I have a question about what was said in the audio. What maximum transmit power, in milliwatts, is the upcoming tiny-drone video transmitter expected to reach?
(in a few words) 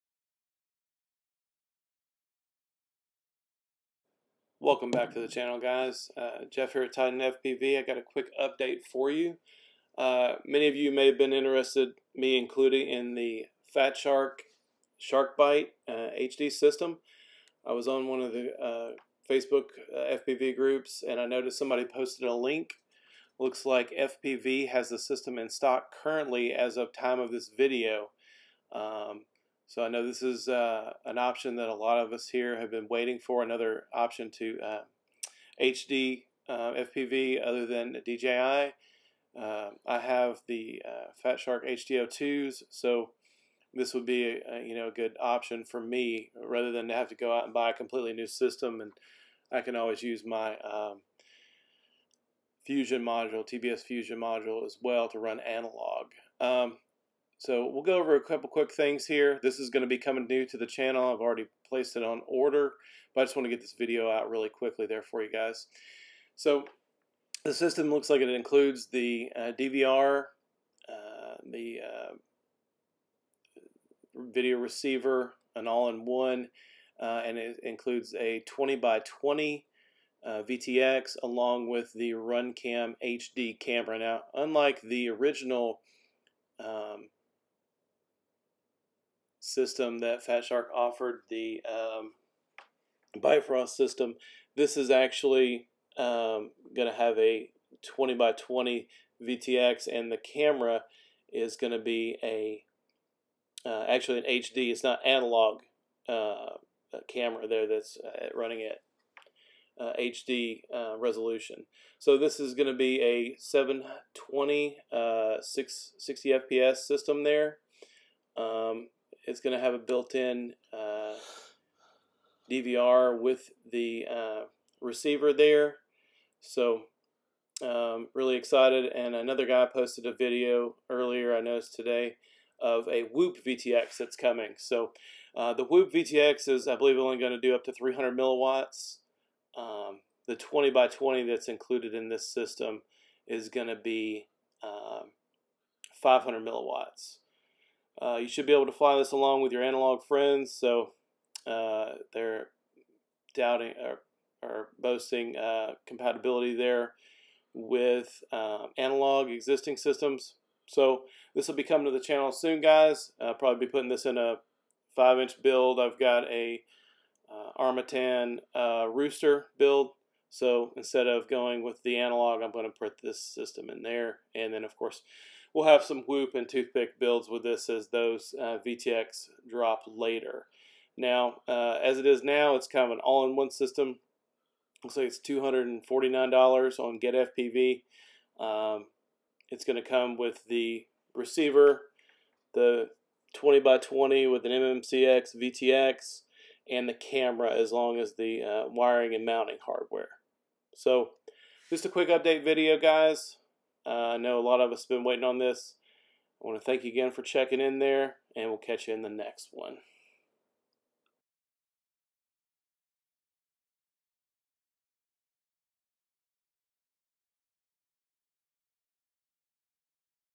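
300 milliwatts.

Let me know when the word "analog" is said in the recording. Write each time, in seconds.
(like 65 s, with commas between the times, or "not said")
55 s, 105 s, 149 s, 158 s, 171 s.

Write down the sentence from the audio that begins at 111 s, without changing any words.
So this is going to be a 720 uh, 6, 60 FPS system there.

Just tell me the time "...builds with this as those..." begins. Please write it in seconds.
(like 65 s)
176 s.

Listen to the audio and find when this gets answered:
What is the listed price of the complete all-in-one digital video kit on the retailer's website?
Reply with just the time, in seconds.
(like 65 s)
185 s.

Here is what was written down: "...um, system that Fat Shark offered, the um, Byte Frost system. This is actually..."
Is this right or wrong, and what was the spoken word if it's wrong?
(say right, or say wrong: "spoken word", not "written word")
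right.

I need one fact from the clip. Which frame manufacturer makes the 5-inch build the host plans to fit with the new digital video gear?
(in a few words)
Armattan.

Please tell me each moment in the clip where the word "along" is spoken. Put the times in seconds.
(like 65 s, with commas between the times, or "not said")
81 s, 149 s.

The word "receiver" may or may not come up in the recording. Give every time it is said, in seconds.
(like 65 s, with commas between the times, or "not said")
74 s, 124 s, 191 s.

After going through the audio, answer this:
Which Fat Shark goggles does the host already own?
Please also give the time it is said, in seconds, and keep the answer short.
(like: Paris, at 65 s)
HD 2, at 41 s.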